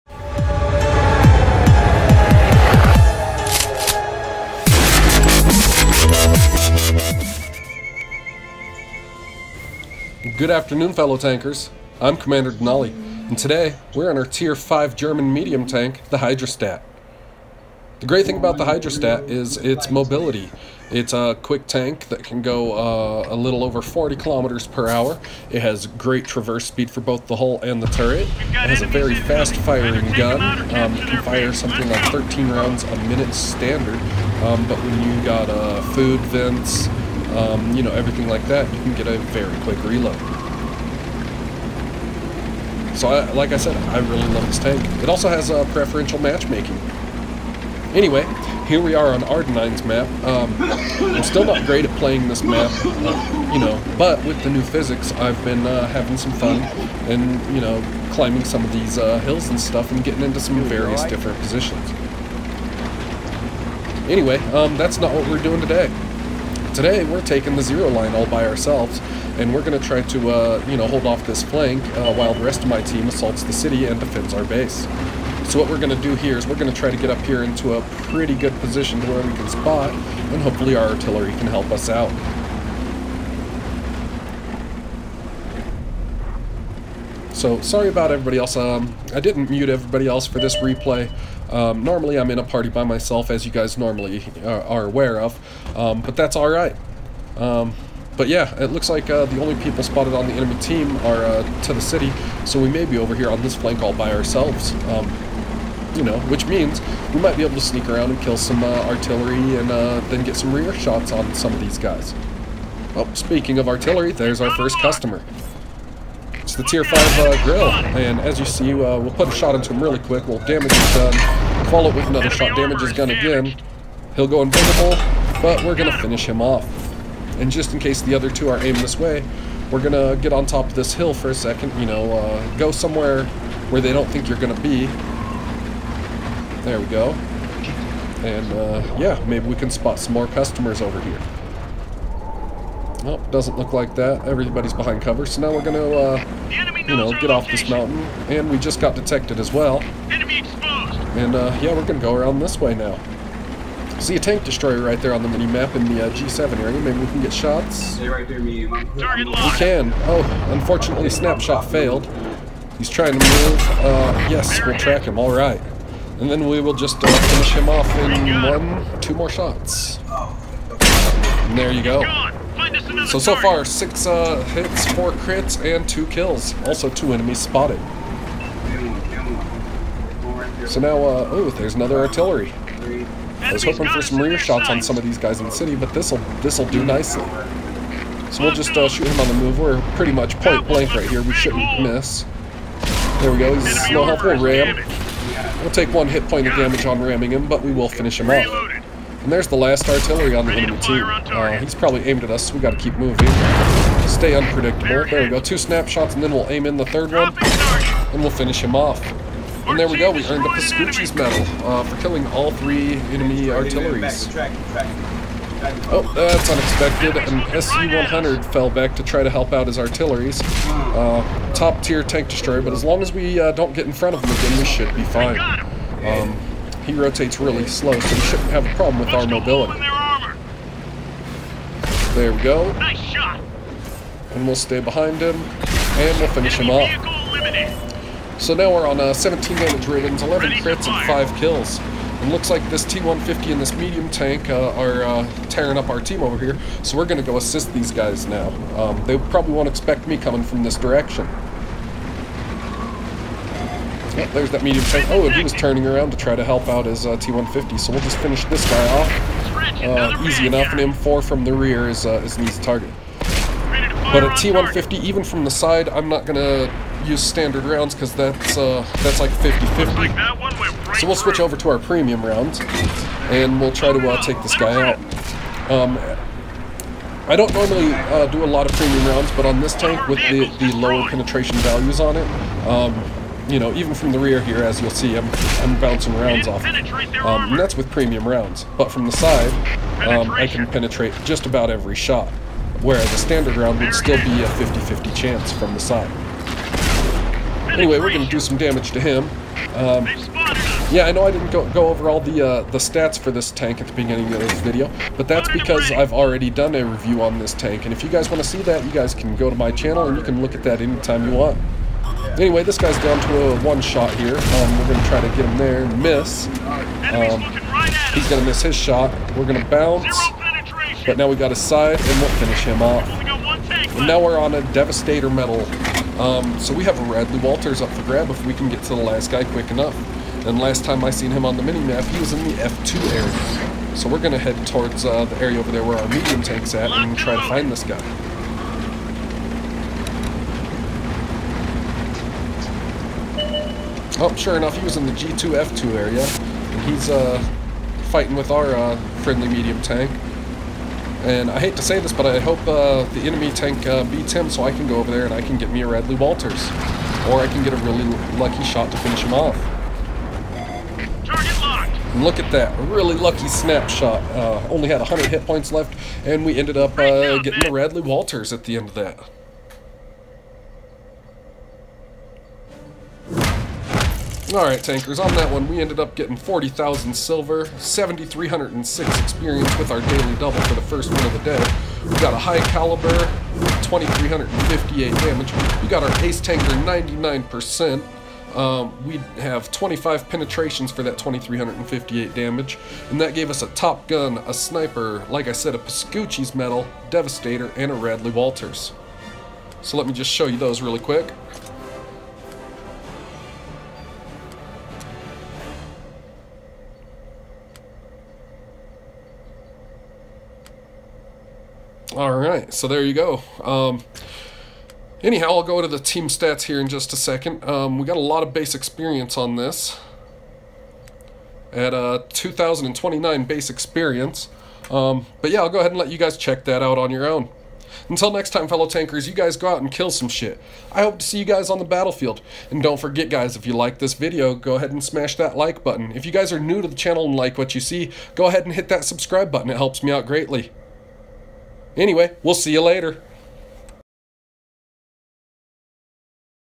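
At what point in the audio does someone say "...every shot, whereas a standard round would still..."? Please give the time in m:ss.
4:51.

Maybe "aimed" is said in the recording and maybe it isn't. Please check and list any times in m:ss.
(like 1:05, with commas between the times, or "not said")
2:08, 3:22.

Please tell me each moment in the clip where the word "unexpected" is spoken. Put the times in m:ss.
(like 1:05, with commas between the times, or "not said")
3:36.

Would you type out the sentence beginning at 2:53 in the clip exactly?
So, so far, six uh, hits, four crits, and two kills.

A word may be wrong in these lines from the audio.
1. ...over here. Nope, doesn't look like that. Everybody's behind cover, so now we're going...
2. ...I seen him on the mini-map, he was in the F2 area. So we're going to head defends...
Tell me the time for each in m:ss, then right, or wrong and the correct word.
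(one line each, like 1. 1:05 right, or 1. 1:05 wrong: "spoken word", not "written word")
1. 2:20 right
2. 5:31 wrong: "towards", not "defends".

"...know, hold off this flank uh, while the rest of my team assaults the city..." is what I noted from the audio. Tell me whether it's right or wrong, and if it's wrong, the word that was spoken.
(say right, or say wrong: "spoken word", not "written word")
right.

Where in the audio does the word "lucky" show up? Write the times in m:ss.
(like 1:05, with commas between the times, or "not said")
5:58, 6:03.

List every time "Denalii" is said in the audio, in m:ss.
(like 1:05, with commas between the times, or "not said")
0:12.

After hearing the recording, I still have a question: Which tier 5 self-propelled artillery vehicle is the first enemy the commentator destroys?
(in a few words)
Grille.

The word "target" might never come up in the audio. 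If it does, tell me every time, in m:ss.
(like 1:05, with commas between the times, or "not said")
4:22, 6:01.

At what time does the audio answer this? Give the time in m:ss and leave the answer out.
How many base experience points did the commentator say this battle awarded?
7:02.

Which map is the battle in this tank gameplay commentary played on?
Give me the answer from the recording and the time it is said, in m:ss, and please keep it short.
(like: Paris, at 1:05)
Ardennes, at 0:49.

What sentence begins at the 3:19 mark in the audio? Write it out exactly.
And there's the last artillery on the enemy team.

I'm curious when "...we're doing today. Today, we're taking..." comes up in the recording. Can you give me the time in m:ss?
1:05.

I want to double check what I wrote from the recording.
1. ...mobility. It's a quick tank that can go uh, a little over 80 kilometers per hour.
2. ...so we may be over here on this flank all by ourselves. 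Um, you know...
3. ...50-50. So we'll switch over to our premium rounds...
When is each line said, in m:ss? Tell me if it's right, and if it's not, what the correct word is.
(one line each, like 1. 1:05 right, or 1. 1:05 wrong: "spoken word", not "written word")
1. 0:19 wrong: "40", not "80"
2. 1:42 right
3. 4:29 right.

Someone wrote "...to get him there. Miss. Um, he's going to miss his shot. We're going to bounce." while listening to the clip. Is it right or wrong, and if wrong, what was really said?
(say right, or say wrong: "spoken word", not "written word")
right.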